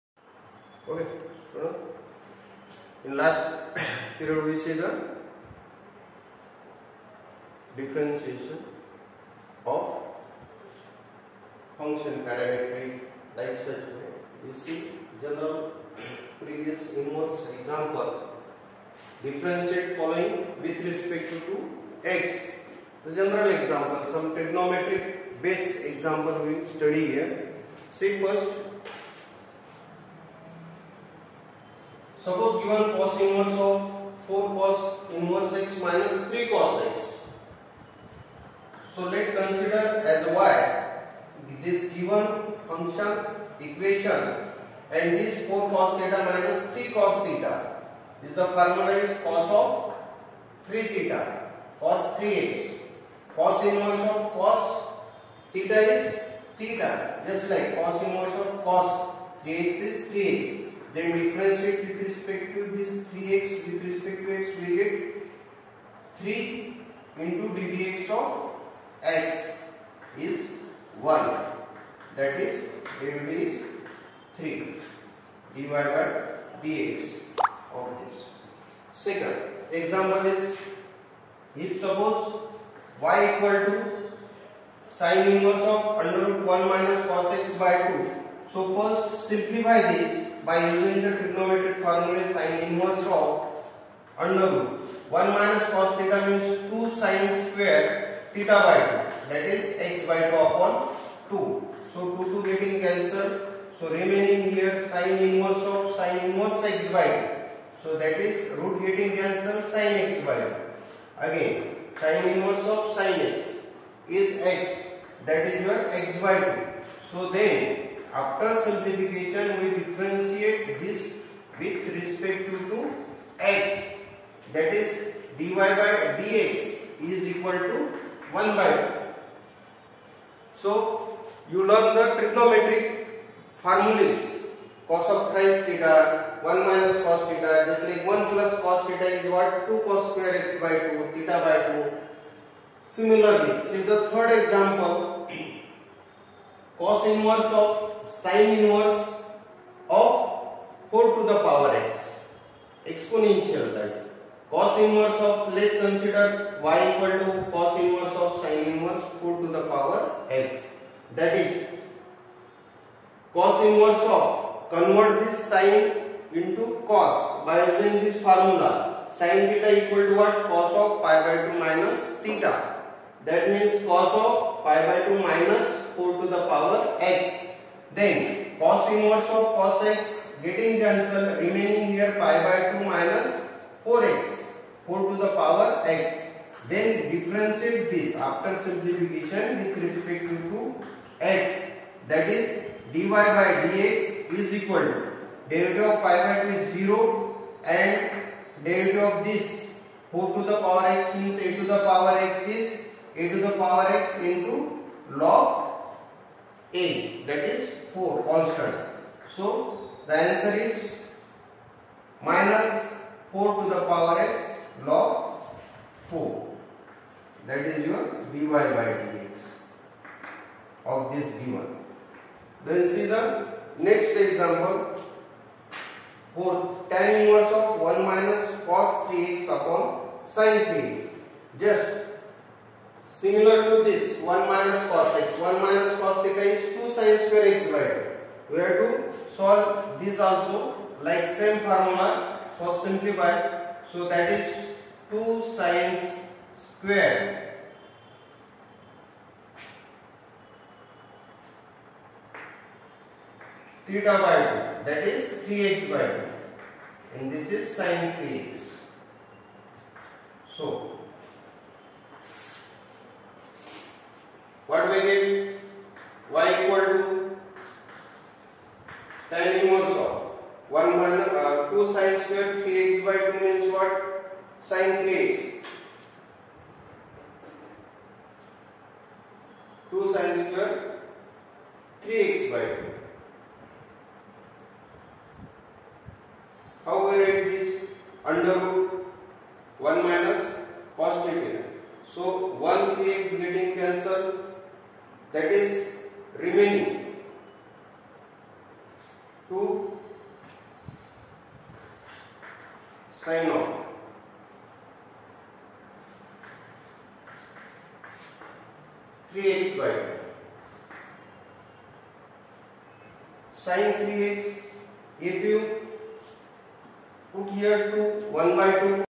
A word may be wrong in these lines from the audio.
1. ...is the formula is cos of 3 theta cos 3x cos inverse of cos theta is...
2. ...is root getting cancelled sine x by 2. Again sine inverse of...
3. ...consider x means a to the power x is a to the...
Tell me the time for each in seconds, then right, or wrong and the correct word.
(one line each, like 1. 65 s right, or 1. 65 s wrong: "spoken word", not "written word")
1. 48 s right
2. 108 s right
3. 200 s wrong: "power", not "consider".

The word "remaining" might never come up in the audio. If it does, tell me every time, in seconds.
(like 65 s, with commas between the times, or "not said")
103 s, 181 s, 296 s.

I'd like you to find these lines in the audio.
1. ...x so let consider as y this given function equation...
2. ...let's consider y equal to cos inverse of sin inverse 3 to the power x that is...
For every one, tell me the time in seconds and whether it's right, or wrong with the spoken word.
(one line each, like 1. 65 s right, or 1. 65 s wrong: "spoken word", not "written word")
1. 36 s right
2. 155 s wrong: "4", not "3".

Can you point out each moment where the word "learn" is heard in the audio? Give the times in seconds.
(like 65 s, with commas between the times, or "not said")
131 s.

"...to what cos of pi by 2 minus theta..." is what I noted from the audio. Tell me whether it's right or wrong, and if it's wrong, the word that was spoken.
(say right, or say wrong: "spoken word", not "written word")
right.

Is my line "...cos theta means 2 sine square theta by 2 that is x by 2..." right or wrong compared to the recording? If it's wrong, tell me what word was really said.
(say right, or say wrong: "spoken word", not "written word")
right.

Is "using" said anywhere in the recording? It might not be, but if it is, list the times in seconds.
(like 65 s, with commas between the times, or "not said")
90 s, 167 s.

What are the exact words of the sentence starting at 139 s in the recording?
2 cos square x by 2, theta by 2.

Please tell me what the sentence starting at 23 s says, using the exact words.
The general example, some trigonometric based example we study here.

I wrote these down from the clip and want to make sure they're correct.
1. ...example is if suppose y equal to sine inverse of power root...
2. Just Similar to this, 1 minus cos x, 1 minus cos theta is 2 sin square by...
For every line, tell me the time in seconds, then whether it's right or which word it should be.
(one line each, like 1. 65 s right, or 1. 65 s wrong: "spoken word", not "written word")
1. 79 s wrong: "under", not "power"
2. 231 s right.